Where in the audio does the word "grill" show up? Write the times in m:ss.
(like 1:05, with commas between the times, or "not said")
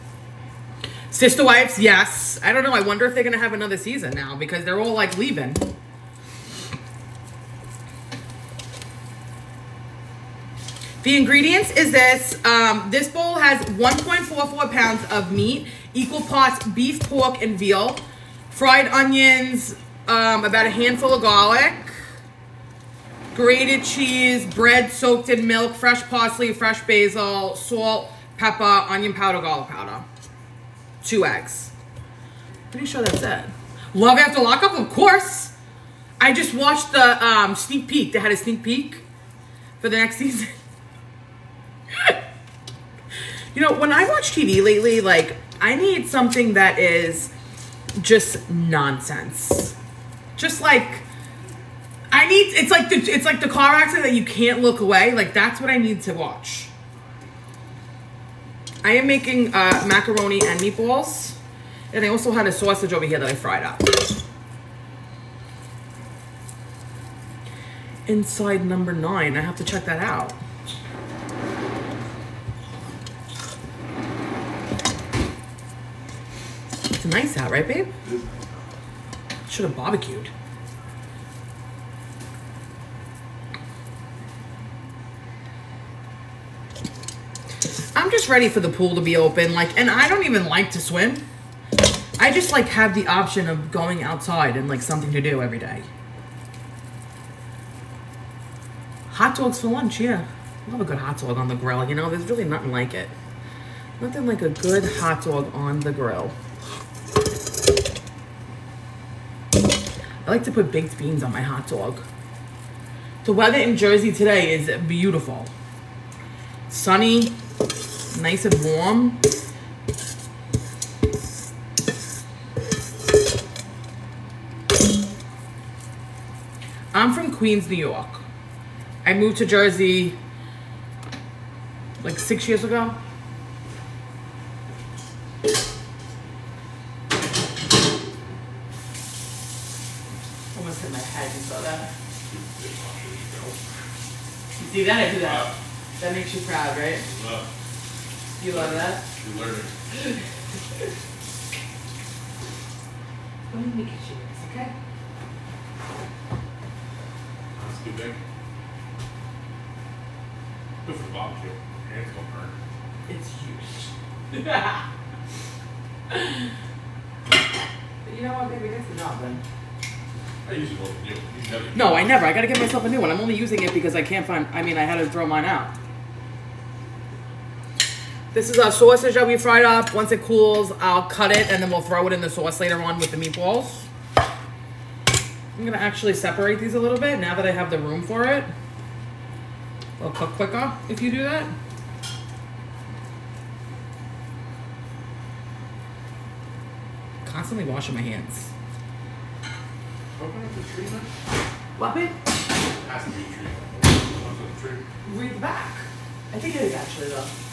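1:41, 1:45.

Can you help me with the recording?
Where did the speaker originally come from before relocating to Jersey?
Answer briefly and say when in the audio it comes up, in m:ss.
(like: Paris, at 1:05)
Queens, New York, at 2:07.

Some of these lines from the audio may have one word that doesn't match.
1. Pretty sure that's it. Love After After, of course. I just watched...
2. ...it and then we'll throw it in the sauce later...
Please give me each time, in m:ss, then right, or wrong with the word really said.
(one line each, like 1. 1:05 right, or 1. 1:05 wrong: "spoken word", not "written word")
1. 0:32 wrong: "Lockup", not "After"
2. 3:01 right.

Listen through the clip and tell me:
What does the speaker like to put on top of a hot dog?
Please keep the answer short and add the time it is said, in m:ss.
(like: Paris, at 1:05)
baked beans, at 1:50.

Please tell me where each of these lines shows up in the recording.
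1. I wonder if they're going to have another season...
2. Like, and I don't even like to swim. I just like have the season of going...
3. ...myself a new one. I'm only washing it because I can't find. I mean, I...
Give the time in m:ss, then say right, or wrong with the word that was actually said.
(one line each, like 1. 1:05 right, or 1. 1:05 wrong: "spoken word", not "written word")
1. 0:02 right
2. 1:29 wrong: "option", not "season"
3. 2:52 wrong: "using", not "washing".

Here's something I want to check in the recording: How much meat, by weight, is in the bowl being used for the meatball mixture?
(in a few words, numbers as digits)
1.44 pounds.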